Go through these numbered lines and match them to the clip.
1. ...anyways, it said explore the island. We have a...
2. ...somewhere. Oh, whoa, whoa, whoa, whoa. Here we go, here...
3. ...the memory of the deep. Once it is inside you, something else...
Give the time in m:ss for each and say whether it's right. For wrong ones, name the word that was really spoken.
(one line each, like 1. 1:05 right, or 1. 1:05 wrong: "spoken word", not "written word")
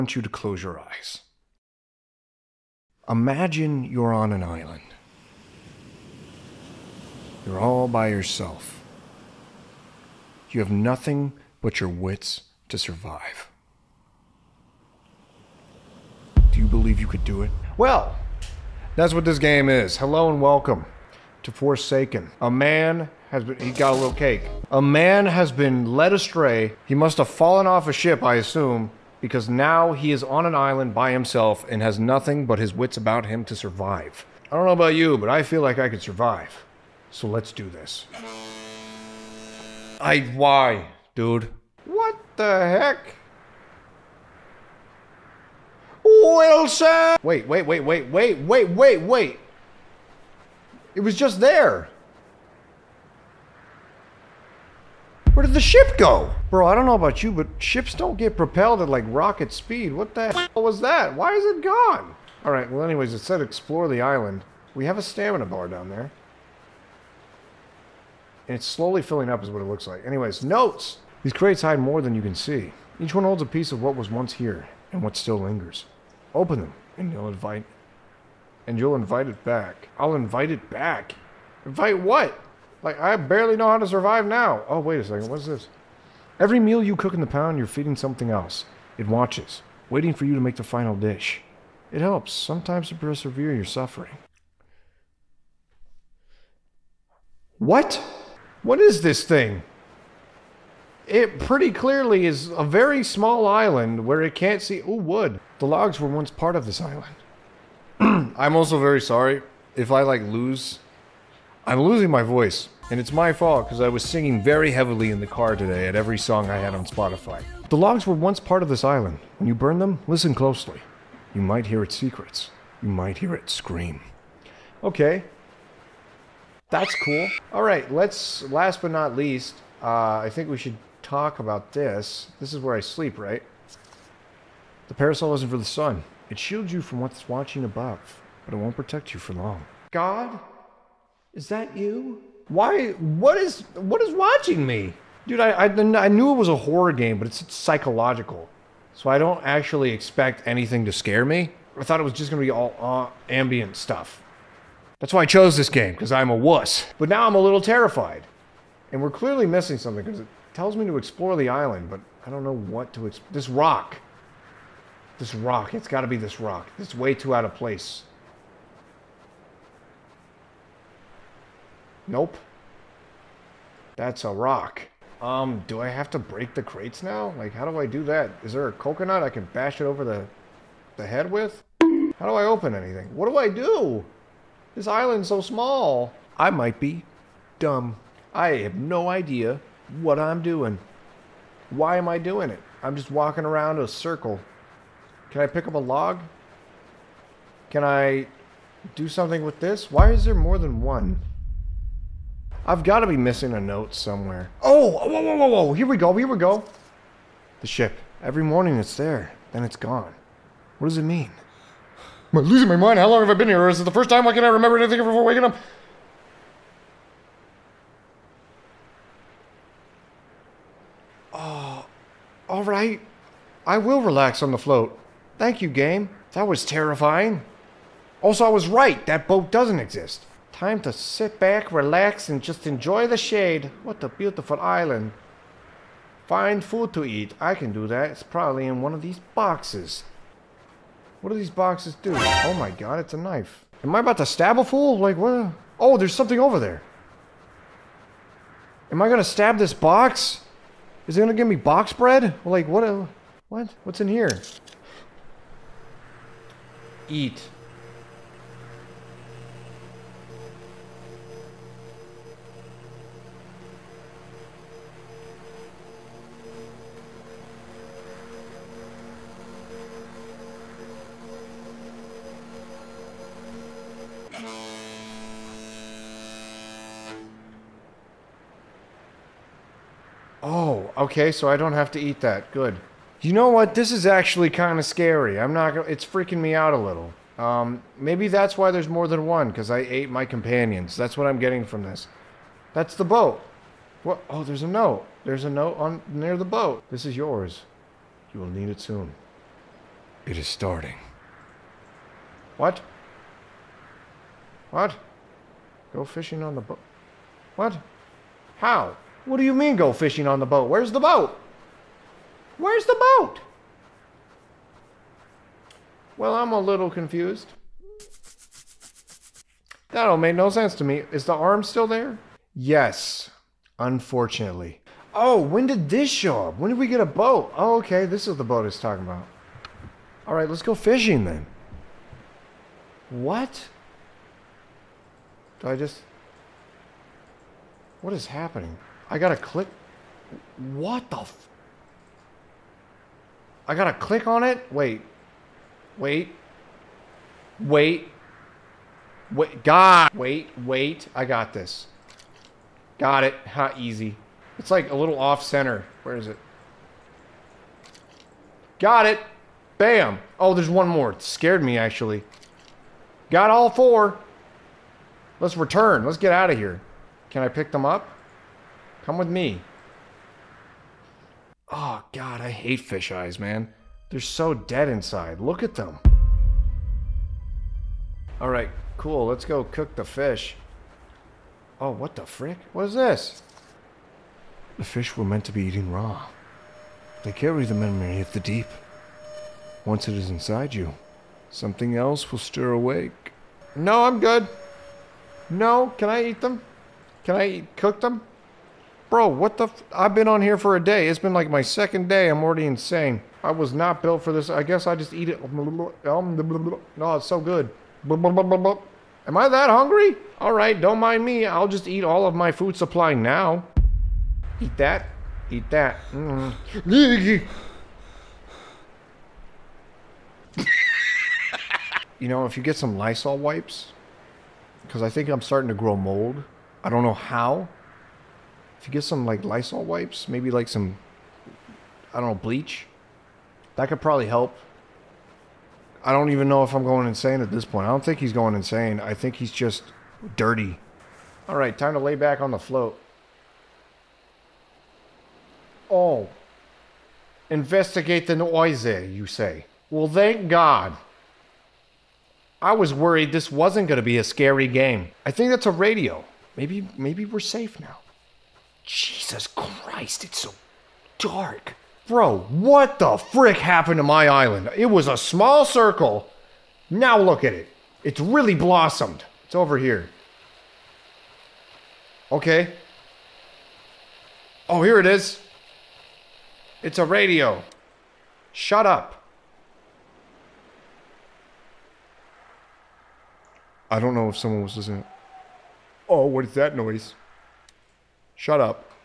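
1. 1:02 right
2. 3:23 right
3. 6:27 right.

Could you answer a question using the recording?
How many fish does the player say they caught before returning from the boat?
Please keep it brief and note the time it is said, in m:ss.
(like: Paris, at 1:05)
4, at 6:03.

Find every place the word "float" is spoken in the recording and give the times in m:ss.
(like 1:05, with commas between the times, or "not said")
3:44, 7:22.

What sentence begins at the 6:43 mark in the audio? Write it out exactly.
I was not built for this.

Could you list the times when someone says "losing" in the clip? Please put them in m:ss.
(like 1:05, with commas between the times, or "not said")
1:51, 3:32.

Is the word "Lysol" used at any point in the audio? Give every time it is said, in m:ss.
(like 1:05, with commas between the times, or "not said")
7:02, 7:09.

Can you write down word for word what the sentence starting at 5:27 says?
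Oh, okay, this is the boat it's talking about.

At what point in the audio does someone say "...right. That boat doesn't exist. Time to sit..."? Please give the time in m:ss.
3:48.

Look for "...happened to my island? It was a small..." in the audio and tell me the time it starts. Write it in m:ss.
7:43.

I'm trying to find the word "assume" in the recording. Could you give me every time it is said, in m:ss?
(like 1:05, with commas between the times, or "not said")
0:28.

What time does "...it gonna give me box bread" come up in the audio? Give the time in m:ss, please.
4:11.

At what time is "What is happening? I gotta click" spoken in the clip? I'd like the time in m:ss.
5:38.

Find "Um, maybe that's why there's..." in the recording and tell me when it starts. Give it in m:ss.
4:47.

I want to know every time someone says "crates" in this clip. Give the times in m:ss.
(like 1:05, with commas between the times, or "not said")
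1:11, 2:56.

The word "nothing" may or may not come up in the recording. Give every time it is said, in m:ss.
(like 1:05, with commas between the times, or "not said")
0:10, 0:31.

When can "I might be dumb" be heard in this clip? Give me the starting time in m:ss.
3:06.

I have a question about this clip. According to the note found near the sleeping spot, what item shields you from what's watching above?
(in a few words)
The parasol.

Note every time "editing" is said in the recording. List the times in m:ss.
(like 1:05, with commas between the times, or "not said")
not said.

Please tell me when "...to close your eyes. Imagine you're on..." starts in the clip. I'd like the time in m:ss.
0:00.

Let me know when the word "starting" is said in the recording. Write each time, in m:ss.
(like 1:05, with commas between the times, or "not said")
5:00, 7:05.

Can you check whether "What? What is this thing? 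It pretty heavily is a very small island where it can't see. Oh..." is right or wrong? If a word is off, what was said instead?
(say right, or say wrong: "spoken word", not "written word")
wrong: "clearly", not "heavily".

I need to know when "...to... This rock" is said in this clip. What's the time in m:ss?
2:42.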